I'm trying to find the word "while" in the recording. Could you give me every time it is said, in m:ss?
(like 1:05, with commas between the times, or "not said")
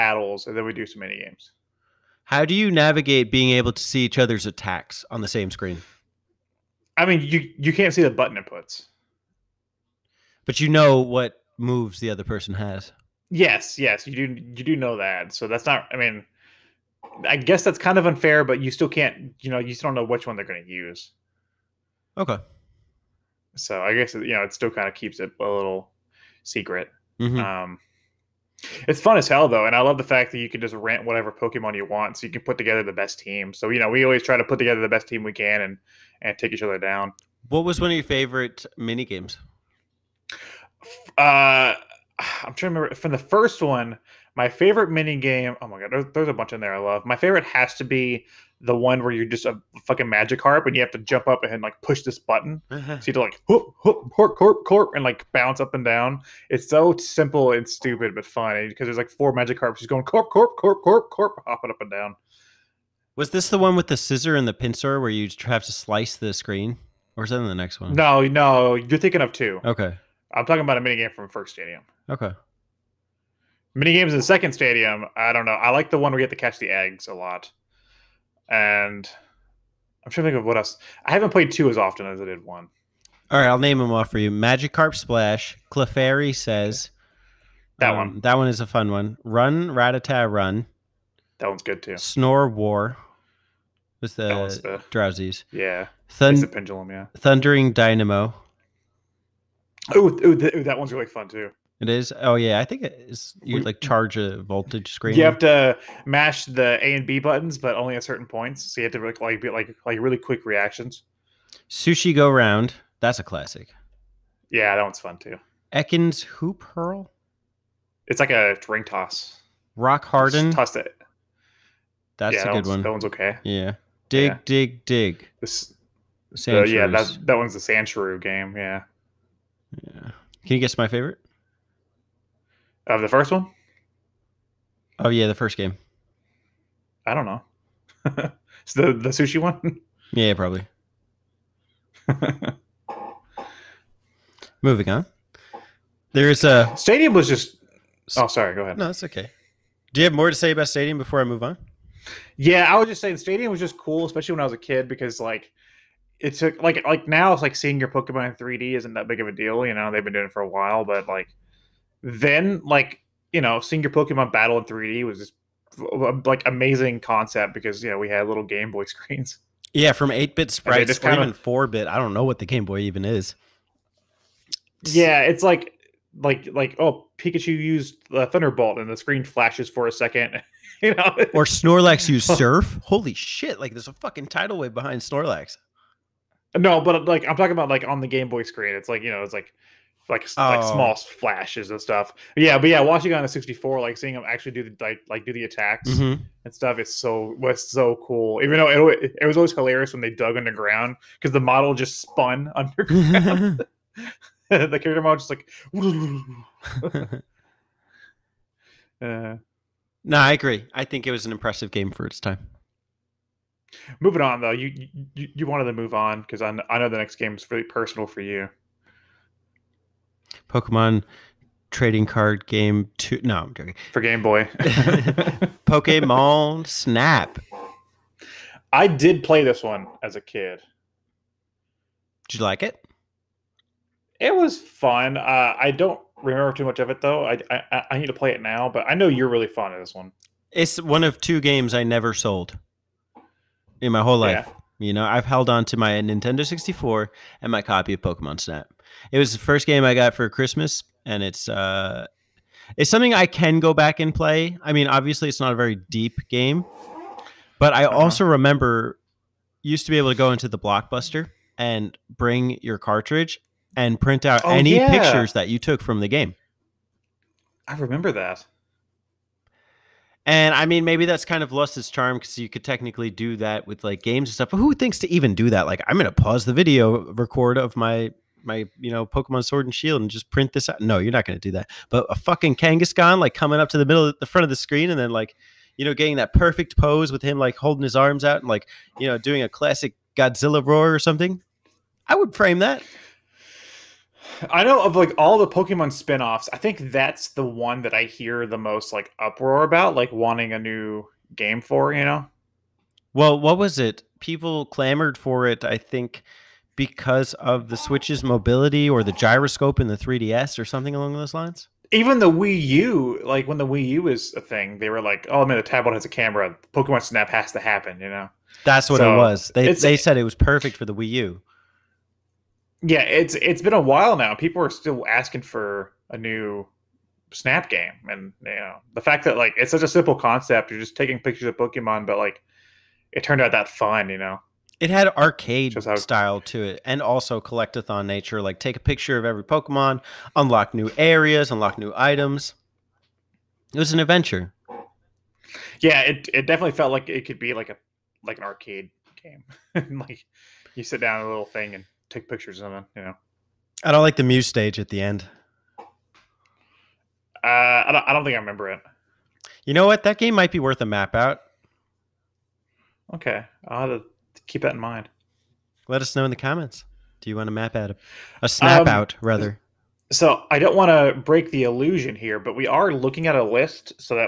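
2:40, 5:23.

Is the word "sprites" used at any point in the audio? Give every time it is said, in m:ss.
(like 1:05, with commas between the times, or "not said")
2:50.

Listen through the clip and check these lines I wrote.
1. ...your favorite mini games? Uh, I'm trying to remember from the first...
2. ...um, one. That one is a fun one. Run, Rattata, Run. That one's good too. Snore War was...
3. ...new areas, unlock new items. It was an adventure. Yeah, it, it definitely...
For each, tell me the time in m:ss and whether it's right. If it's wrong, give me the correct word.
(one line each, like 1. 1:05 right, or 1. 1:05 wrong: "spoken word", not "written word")
1. 0:37 right
2. 1:27 right
3. 5:40 right.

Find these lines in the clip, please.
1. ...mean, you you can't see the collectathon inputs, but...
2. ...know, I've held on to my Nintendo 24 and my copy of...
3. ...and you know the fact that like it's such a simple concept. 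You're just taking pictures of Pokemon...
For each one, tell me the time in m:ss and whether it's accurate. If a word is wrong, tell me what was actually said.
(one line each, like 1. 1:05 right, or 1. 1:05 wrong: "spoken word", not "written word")
1. 0:07 wrong: "button", not "collectathon"
2. 4:04 wrong: "64", not "24"
3. 5:28 right.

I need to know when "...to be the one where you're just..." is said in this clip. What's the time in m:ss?
0:47.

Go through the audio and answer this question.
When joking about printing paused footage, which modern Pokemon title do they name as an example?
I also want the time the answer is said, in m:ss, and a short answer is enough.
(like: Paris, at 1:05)
Pokemon Sword and Shield, at 4:39.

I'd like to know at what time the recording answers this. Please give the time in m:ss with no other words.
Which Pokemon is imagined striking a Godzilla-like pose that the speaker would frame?
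4:42.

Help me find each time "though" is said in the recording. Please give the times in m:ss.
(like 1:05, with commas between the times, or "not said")
0:29, 3:18, 3:34, 3:57.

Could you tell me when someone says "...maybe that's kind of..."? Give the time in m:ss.
4:30.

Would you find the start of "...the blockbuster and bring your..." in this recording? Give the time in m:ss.
4:20.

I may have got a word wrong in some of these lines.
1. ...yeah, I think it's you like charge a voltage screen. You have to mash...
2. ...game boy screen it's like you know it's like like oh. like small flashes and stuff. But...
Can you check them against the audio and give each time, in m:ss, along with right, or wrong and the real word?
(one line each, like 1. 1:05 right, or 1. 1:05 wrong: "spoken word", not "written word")
1. 1:42 right
2. 3:08 right.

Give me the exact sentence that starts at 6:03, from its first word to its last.
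Okay, I'll have to keep that in mind.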